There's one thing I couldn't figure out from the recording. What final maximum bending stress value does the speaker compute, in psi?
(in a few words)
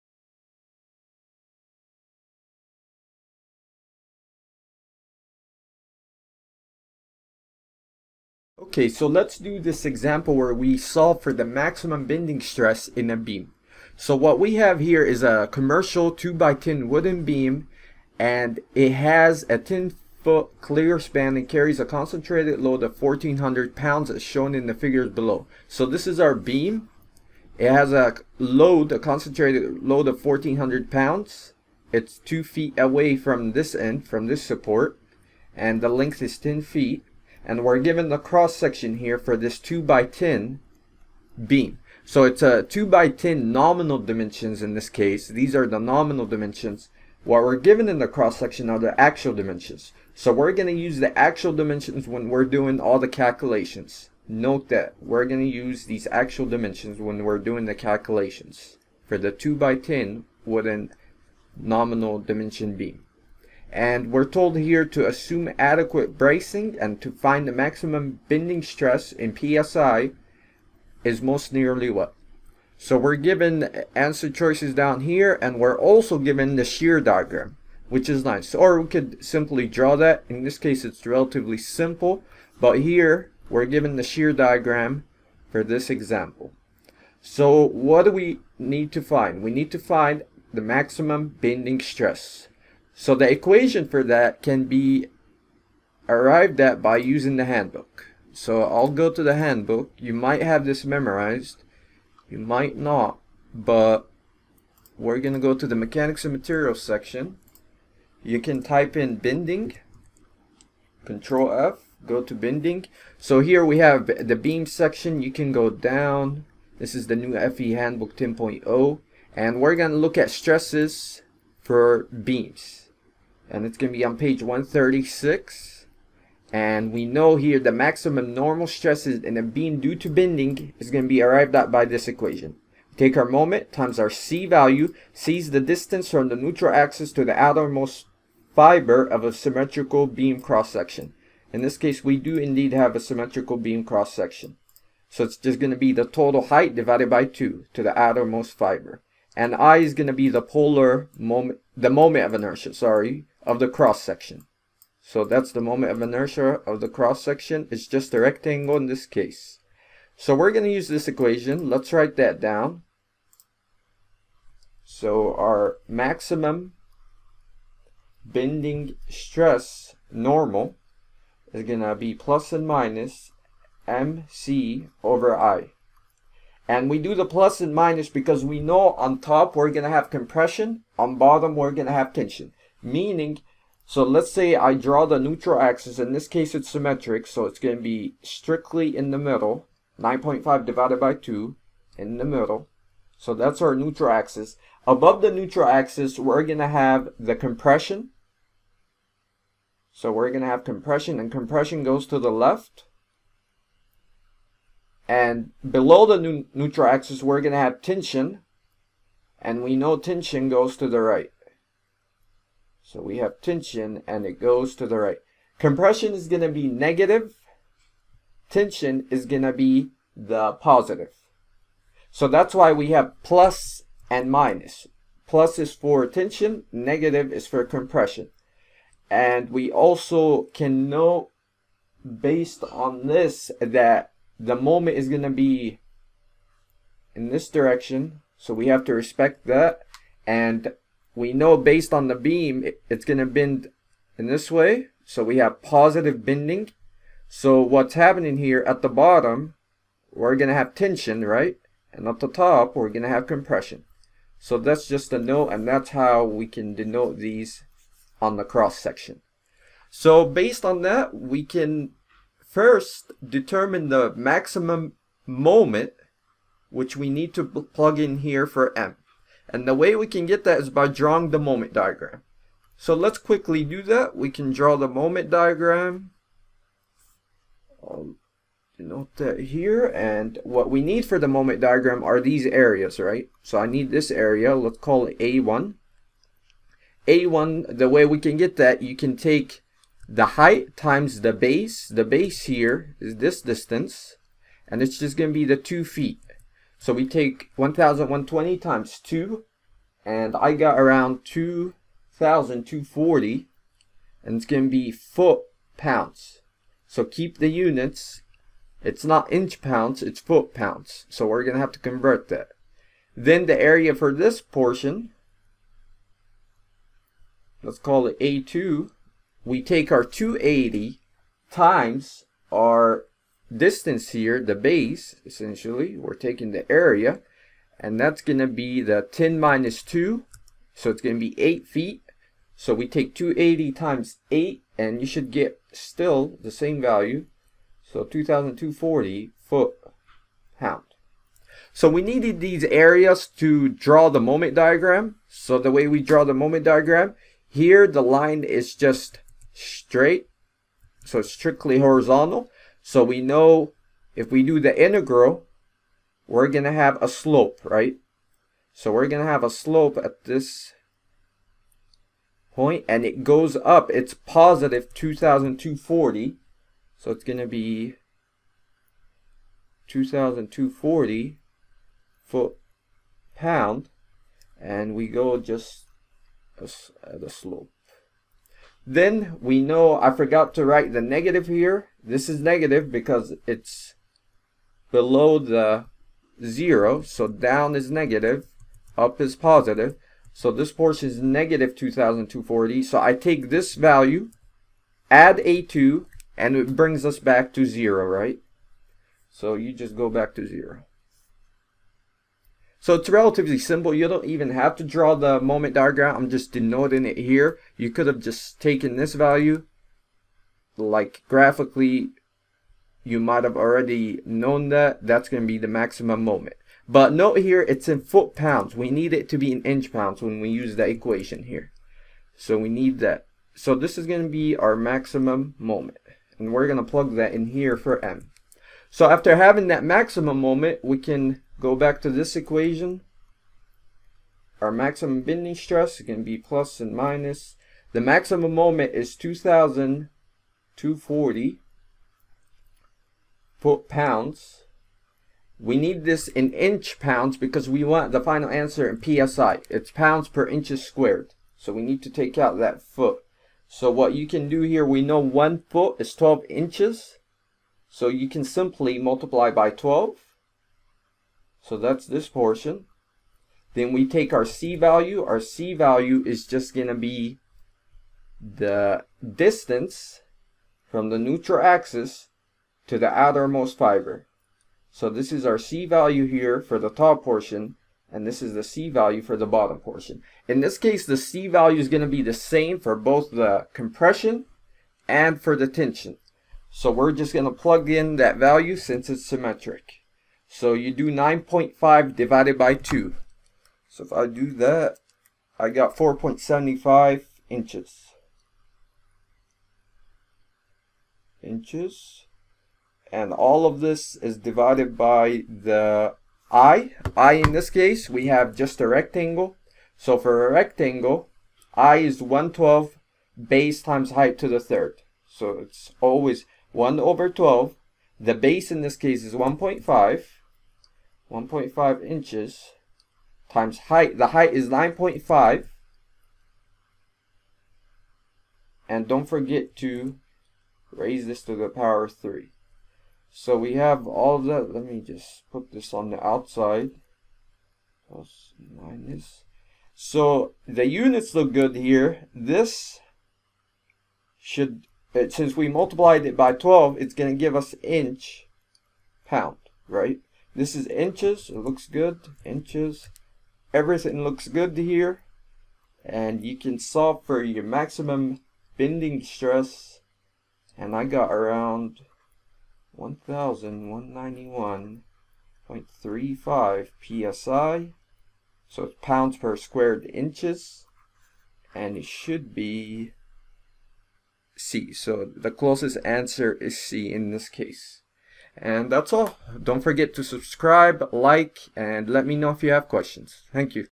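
1191.35 psi.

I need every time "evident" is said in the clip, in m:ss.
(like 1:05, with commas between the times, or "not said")
not said.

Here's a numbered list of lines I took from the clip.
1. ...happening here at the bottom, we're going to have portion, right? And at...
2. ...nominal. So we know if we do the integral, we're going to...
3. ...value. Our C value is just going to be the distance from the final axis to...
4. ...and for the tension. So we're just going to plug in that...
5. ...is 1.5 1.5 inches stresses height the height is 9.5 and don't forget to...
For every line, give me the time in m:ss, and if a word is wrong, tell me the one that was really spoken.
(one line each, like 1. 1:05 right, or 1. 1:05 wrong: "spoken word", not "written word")
1. 4:07 wrong: "tension", not "portion"
2. 5:51 wrong: "horizontal", not "nominal"
3. 7:44 wrong: "neutral", not "final"
4. 8:05 right
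5. 8:39 wrong: "times", not "stresses".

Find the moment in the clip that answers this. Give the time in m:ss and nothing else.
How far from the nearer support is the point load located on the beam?
0:32.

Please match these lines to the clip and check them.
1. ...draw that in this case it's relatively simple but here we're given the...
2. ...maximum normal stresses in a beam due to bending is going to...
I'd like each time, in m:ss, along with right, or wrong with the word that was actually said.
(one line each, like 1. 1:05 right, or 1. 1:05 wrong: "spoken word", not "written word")
1. 1:19 right
2. 2:07 right.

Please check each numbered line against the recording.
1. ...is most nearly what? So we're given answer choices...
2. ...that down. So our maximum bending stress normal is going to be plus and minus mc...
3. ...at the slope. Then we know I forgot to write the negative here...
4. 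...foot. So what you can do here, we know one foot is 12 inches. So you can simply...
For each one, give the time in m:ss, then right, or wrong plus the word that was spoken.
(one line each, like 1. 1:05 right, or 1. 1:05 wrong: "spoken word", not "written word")
1. 1:11 right
2. 2:42 right
3. 6:16 right
4. 7:32 right.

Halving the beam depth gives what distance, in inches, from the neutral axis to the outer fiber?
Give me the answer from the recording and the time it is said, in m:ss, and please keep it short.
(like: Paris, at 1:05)
4.75 inches, at 8:15.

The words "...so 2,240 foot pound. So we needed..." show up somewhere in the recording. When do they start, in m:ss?
5:37.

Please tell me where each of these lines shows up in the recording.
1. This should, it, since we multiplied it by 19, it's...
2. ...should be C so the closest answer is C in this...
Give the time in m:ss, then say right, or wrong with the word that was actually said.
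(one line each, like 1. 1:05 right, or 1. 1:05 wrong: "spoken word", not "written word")
1. 9:02 wrong: "12", not "19"
2. 9:32 right.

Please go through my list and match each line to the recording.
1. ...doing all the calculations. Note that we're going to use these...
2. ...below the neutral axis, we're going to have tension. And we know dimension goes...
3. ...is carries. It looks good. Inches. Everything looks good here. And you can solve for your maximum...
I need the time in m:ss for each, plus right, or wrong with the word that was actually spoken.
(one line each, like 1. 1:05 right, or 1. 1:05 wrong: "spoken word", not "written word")
1. 0:52 right
2. 3:25 wrong: "tension", not "dimension"
3. 9:10 wrong: "inches", not "carries".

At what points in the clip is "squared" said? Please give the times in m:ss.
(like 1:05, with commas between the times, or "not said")
7:30, 9:29.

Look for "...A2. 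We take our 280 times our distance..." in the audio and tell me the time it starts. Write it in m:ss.
5:18.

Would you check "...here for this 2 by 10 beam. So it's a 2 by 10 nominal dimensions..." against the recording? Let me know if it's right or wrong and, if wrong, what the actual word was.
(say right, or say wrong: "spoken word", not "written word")
right.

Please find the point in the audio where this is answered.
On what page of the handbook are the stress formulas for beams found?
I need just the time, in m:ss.
2:04.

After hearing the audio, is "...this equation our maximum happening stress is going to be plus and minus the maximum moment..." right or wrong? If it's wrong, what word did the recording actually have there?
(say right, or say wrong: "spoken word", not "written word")
wrong: "bending", not "happening".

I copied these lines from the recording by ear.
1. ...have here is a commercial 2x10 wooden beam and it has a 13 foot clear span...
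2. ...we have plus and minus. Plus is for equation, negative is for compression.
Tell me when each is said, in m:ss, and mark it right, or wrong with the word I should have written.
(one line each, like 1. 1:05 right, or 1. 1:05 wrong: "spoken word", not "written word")
1. 0:14 wrong: "10", not "13"
2. 3:42 wrong: "tension", not "equation".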